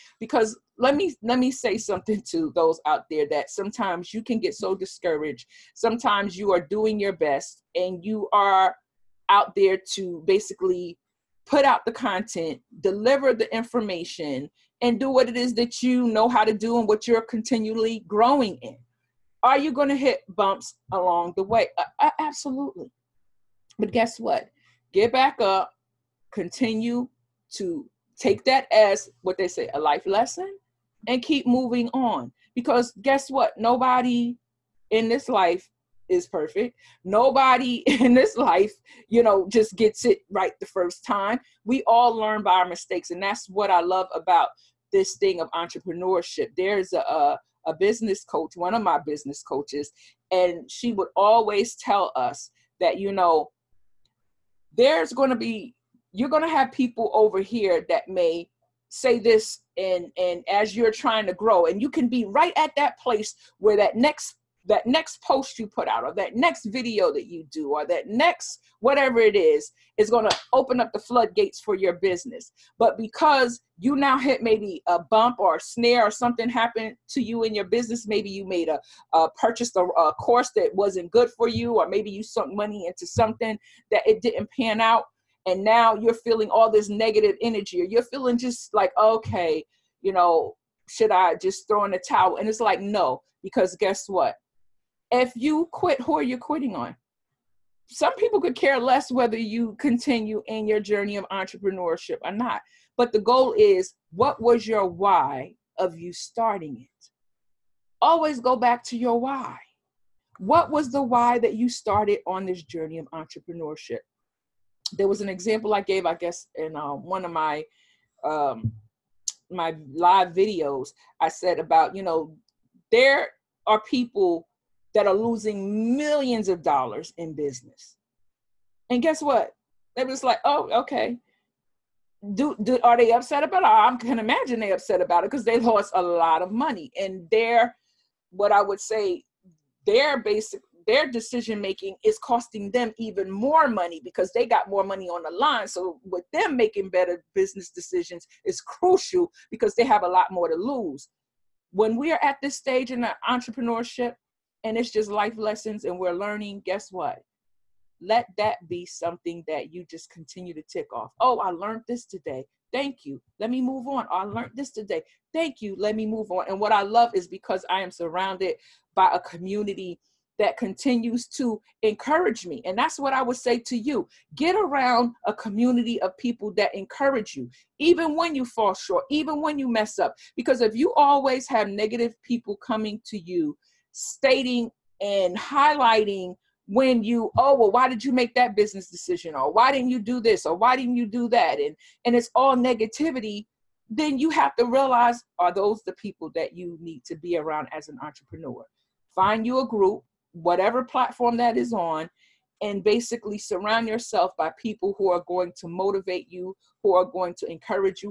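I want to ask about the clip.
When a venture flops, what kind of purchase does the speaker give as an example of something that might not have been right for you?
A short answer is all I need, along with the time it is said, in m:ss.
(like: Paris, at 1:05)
A course, at 1:19.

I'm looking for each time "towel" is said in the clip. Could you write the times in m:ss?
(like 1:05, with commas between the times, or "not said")
1:32.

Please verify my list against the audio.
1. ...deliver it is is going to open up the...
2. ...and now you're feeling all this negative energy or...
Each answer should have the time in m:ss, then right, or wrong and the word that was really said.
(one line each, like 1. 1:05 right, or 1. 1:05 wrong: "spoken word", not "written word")
1. 1:08 wrong: "whatever", not "deliver"
2. 1:25 right.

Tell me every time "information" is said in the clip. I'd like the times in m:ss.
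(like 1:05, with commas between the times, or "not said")
0:13.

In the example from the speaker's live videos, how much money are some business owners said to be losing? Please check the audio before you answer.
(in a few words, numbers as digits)
Millions of dollars.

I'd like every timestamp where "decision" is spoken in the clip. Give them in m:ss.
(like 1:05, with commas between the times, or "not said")
2:21, 2:27, 3:08.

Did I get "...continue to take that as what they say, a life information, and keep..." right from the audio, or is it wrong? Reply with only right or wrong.
wrong.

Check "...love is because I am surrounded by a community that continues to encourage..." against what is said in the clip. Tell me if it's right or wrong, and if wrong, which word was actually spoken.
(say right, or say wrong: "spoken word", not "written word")
right.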